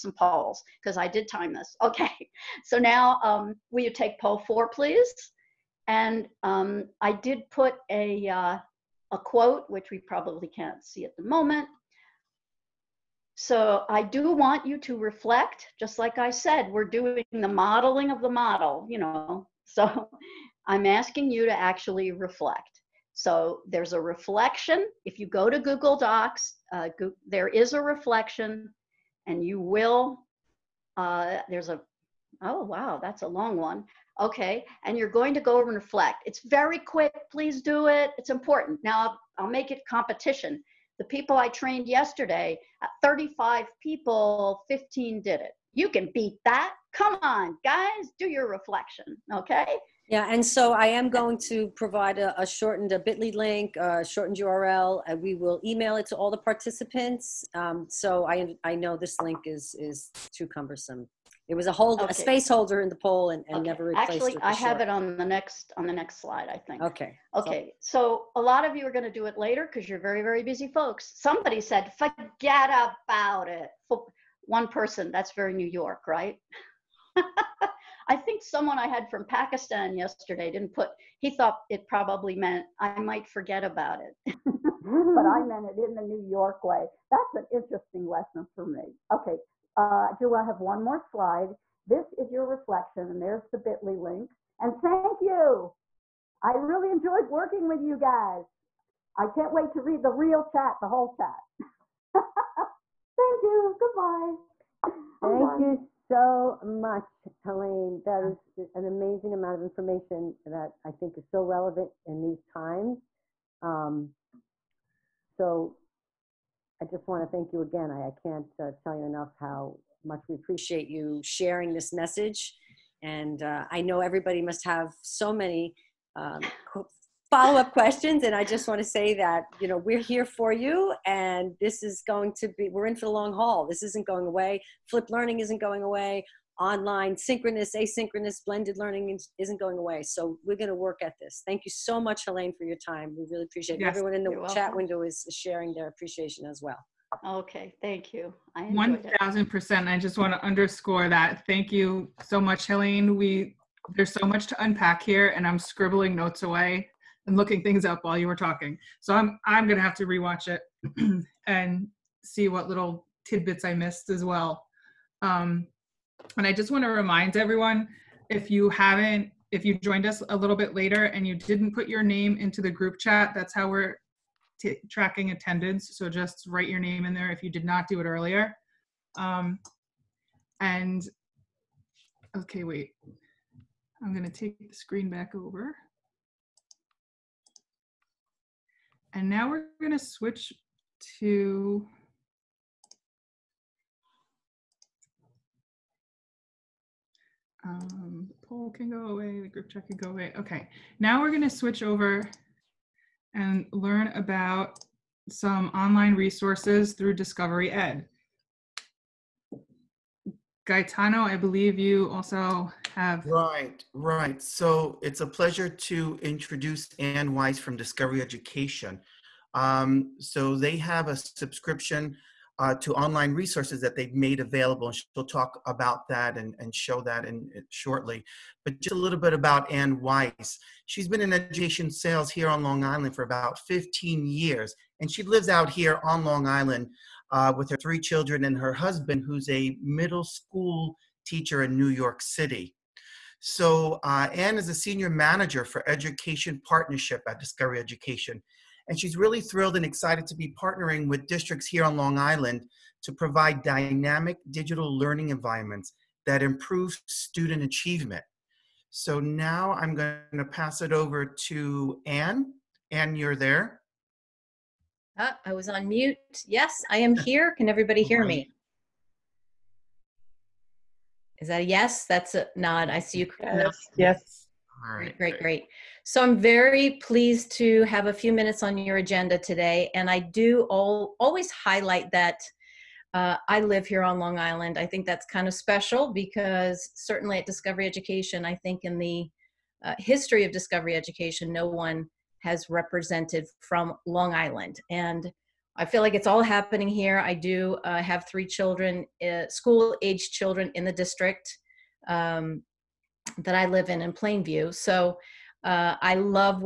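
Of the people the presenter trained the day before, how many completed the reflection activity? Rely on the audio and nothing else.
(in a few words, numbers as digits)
15.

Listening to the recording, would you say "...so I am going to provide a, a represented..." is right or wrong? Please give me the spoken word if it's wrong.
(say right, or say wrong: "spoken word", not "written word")
wrong: "shortened", not "represented".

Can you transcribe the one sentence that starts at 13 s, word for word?
So I do want you to reflect, just like I said, we're doing the modeling of the model, you know.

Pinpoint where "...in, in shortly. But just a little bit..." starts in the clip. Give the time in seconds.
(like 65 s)
227 s.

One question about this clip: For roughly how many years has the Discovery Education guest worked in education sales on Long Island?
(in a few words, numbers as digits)
15 years.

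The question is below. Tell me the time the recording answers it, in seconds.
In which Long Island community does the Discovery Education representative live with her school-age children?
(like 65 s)
304 s.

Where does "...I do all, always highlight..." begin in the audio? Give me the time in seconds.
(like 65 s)
280 s.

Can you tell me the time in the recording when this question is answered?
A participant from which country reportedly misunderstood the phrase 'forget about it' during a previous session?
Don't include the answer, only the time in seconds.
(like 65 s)
79 s.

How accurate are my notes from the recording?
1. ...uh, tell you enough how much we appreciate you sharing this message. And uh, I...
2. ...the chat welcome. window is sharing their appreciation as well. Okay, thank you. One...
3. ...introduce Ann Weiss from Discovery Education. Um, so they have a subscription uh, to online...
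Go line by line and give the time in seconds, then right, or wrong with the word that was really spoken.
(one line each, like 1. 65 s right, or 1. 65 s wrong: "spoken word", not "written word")
1. 118 s right
2. 144 s right
3. 216 s right.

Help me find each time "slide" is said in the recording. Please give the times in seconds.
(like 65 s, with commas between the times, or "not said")
66 s, 90 s.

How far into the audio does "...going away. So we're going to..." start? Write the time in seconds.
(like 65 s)
139 s.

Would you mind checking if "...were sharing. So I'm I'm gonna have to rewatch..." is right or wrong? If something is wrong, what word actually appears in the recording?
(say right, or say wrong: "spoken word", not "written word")
wrong: "talking", not "sharing".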